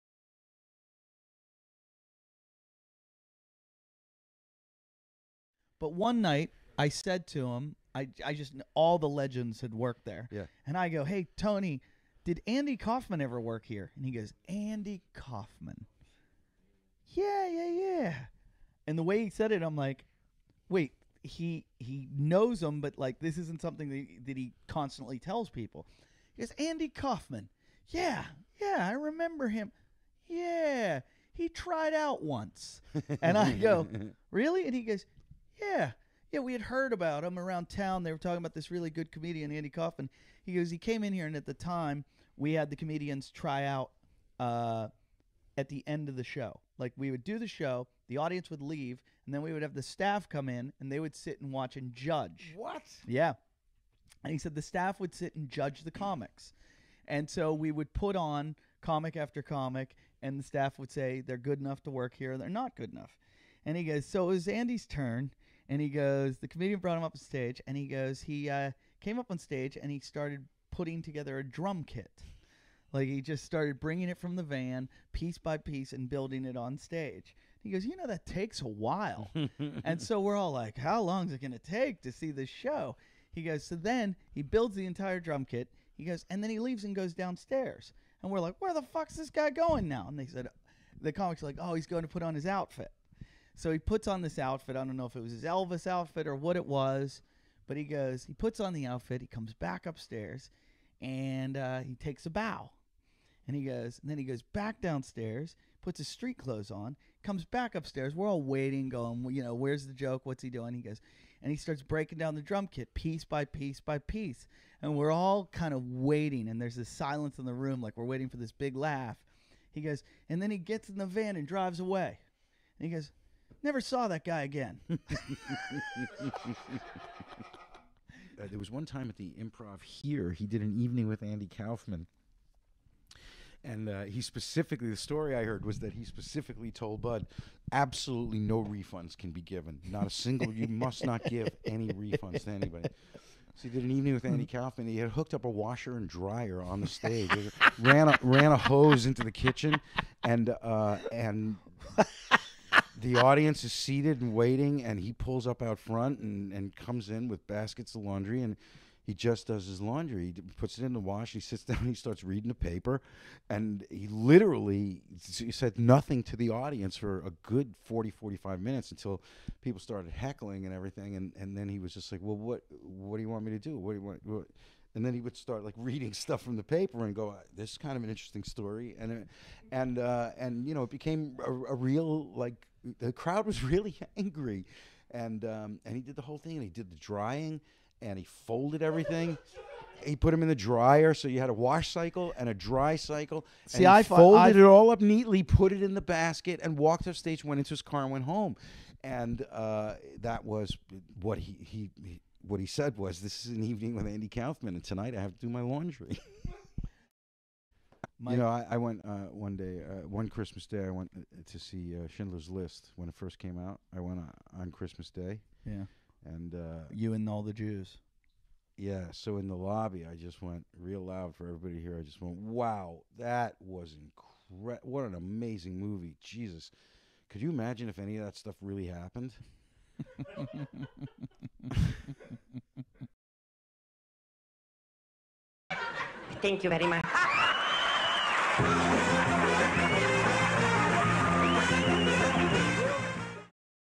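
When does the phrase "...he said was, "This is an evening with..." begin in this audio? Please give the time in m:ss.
3:22.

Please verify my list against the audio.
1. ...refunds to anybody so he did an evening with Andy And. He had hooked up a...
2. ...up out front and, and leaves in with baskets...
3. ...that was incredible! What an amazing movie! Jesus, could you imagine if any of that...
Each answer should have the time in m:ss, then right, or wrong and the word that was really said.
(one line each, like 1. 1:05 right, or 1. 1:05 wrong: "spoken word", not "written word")
1. 2:21 wrong: "Kaufman", not "And"
2. 2:35 wrong: "comes", not "leaves"
3. 3:43 right.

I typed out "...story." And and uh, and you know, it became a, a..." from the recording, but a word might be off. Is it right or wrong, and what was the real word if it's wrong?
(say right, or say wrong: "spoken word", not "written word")
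right.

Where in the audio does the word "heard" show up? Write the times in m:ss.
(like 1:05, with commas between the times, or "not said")
0:36, 2:15.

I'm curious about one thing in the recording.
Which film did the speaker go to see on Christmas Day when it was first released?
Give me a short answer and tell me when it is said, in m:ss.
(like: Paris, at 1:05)
Schindler's List, at 3:32.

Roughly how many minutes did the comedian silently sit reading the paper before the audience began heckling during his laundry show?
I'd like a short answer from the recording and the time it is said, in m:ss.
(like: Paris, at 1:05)
40 to 45 minutes, at 2:47.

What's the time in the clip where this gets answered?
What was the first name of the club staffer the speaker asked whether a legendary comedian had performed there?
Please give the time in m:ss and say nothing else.
0:11.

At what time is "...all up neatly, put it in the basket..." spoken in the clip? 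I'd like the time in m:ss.
3:14.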